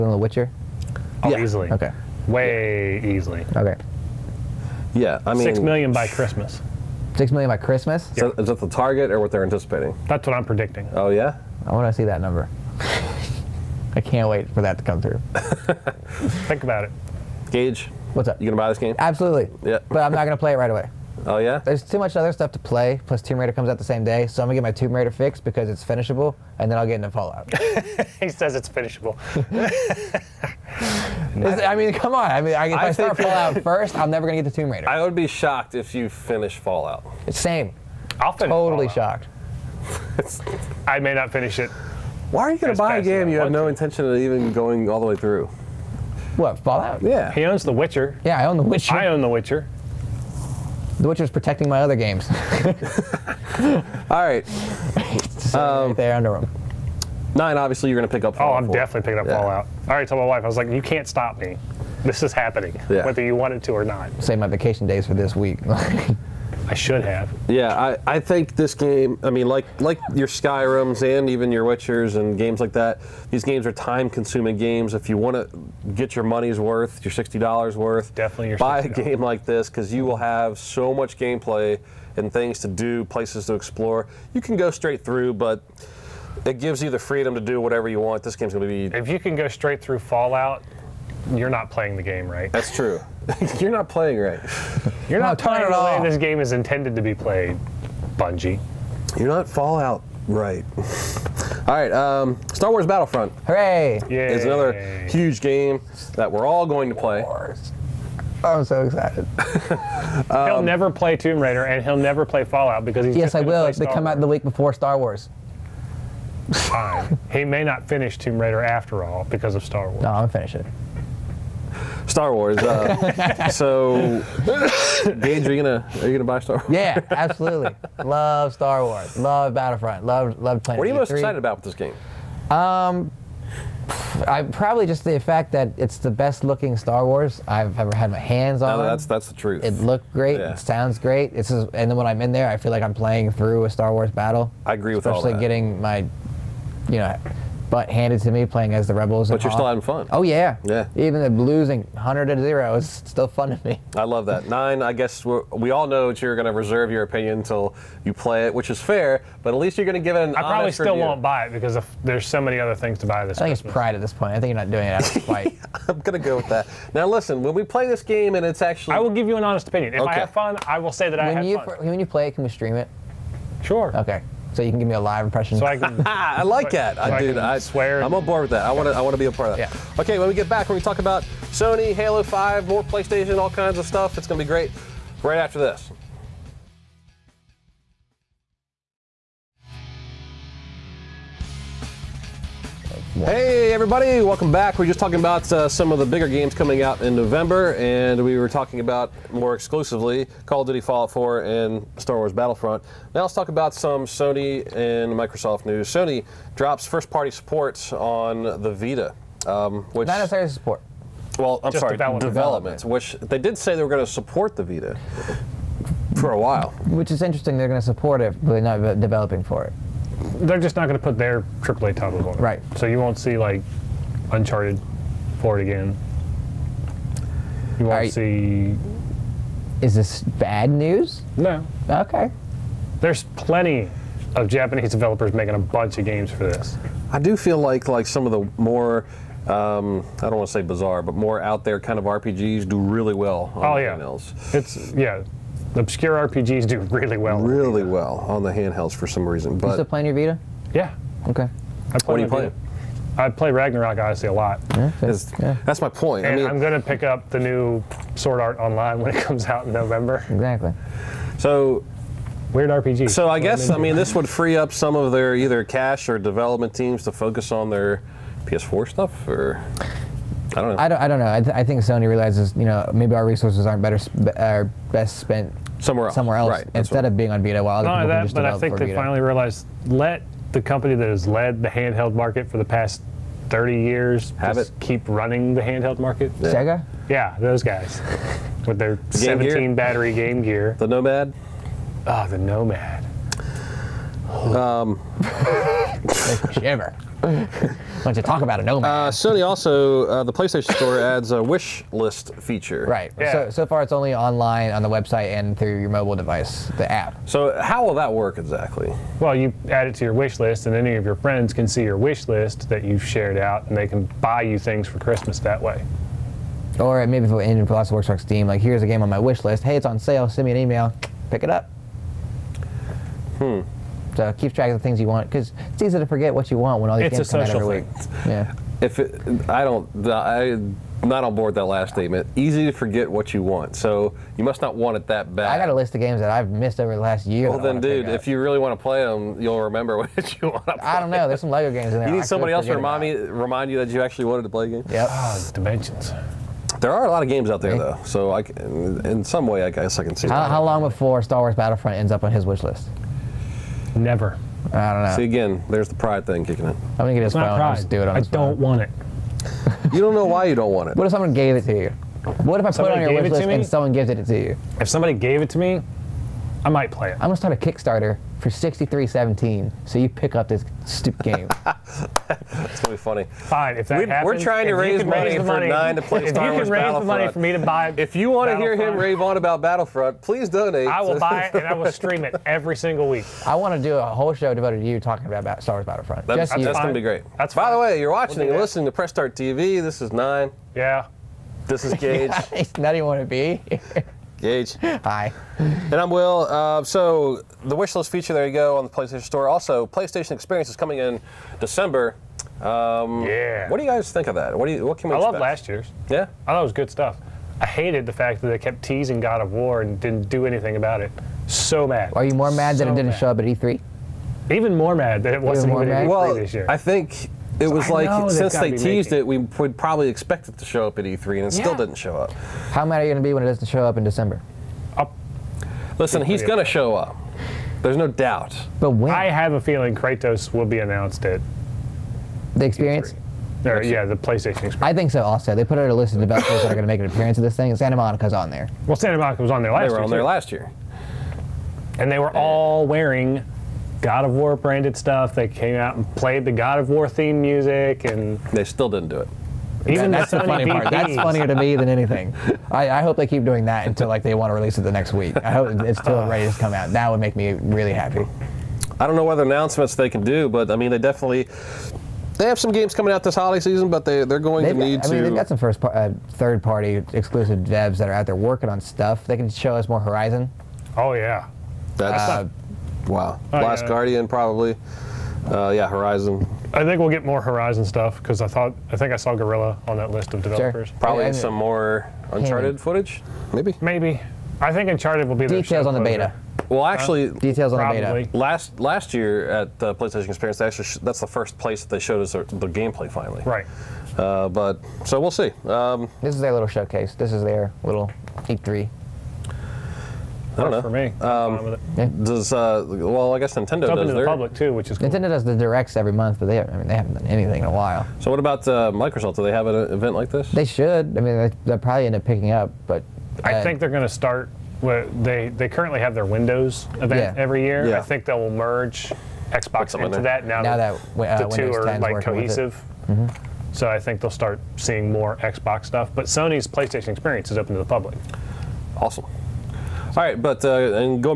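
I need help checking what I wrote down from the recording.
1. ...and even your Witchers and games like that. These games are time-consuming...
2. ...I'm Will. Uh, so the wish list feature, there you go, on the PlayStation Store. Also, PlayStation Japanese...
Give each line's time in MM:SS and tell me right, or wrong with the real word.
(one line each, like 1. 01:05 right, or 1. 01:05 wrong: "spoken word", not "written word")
1. 01:11 right
2. 06:35 wrong: "Experience", not "Japanese".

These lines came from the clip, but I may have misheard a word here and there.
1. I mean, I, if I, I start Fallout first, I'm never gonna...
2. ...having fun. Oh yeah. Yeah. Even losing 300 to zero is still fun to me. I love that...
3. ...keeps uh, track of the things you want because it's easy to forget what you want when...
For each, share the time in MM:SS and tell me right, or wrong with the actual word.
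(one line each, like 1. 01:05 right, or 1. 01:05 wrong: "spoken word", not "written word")
1. 00:32 right
2. 02:29 wrong: "100", not "300"
3. 05:24 right.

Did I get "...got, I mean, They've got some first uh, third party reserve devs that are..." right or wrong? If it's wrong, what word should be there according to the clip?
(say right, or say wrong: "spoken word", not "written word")
wrong: "exclusive", not "reserve".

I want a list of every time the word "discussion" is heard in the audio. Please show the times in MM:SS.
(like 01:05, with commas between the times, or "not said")
not said.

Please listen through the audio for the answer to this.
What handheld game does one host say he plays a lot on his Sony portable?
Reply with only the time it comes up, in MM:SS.
04:13.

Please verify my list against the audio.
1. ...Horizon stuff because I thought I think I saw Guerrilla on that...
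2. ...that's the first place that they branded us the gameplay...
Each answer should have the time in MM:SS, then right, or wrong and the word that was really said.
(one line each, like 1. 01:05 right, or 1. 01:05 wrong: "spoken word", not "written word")
1. 07:57 right
2. 08:11 wrong: "showed", not "branded".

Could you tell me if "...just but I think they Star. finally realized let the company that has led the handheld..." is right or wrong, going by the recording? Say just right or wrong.
wrong.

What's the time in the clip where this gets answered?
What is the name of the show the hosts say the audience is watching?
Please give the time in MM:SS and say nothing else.
06:28.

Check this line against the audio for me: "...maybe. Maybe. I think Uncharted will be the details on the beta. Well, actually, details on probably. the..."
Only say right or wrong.
right.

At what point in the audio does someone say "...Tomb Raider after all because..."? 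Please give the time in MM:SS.
01:58.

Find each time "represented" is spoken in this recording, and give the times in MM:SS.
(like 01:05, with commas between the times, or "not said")
not said.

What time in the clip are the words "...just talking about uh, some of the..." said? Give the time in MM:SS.
03:14.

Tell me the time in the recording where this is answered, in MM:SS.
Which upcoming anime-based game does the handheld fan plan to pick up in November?
04:18.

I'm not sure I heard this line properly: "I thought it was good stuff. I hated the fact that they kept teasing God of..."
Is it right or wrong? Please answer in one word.
right.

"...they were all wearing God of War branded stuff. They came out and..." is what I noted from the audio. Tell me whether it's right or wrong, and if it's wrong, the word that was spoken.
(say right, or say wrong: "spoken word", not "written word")
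right.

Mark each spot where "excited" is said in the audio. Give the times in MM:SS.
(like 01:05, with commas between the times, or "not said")
01:48, 02:11.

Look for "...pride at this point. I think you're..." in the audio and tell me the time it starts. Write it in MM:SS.
02:43.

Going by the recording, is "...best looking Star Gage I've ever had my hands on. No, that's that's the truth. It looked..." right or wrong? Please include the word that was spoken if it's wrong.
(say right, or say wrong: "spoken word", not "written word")
wrong: "Wars", not "Gage".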